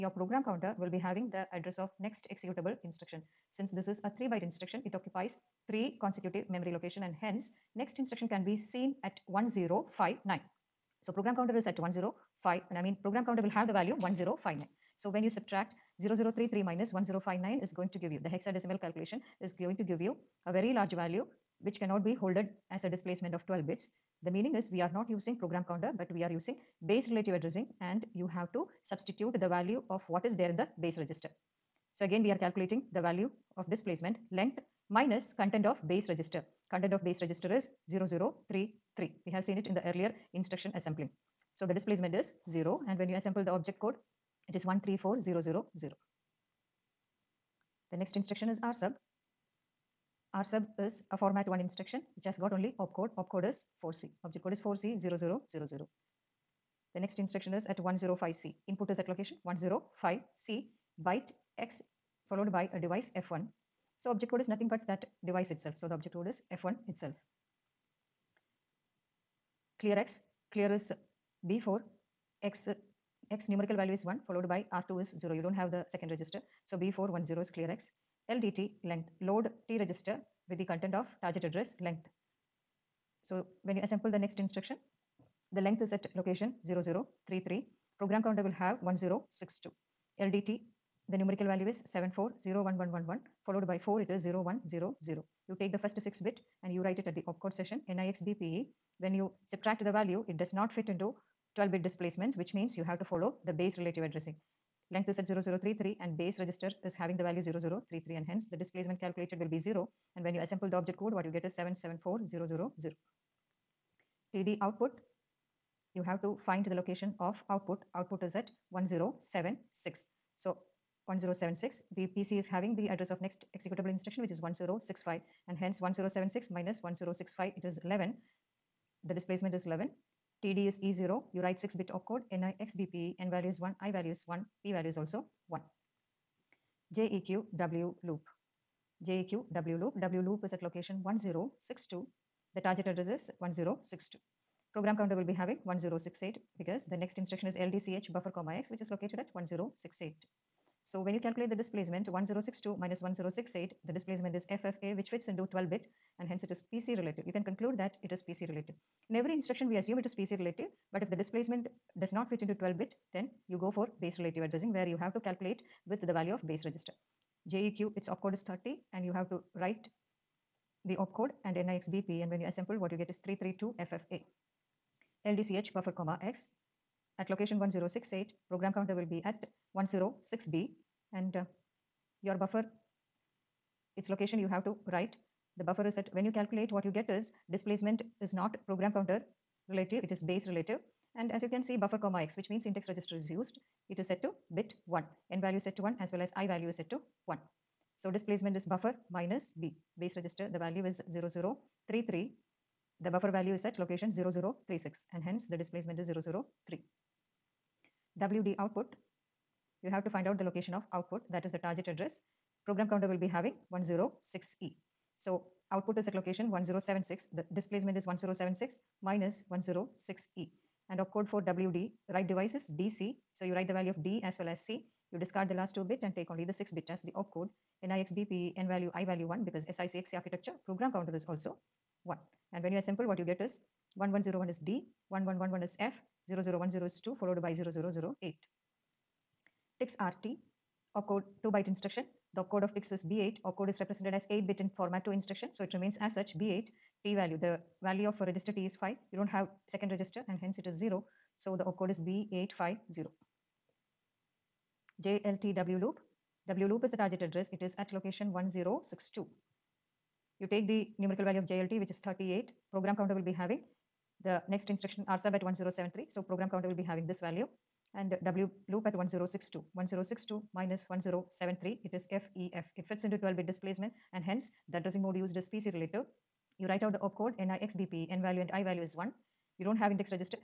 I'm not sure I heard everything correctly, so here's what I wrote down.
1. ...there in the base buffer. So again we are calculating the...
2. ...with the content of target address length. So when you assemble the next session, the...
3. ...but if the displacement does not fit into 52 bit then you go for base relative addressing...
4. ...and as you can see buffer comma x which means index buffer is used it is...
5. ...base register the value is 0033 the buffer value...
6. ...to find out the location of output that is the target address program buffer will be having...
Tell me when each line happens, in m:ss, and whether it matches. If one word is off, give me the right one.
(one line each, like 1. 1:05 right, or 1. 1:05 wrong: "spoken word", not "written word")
1. 0:30 wrong: "register", not "buffer"
2. 1:20 wrong: "instruction", not "session"
3. 2:40 wrong: "12", not "52"
4. 3:11 wrong: "register", not "buffer"
5. 3:20 right
6. 3:30 wrong: "counter", not "buffer".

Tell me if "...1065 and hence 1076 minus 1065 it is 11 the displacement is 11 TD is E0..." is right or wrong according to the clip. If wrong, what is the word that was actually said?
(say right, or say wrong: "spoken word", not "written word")
right.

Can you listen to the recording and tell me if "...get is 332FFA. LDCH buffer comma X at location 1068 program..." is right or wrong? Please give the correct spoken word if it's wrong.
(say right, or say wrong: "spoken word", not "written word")
right.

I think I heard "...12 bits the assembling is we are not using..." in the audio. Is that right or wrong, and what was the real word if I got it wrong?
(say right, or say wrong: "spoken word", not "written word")
wrong: "meaning", not "assembling".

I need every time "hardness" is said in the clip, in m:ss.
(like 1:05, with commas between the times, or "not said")
not said.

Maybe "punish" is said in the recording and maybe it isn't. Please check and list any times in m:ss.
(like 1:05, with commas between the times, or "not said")
not said.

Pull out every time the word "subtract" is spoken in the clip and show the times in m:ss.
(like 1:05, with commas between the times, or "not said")
0:15, 1:39.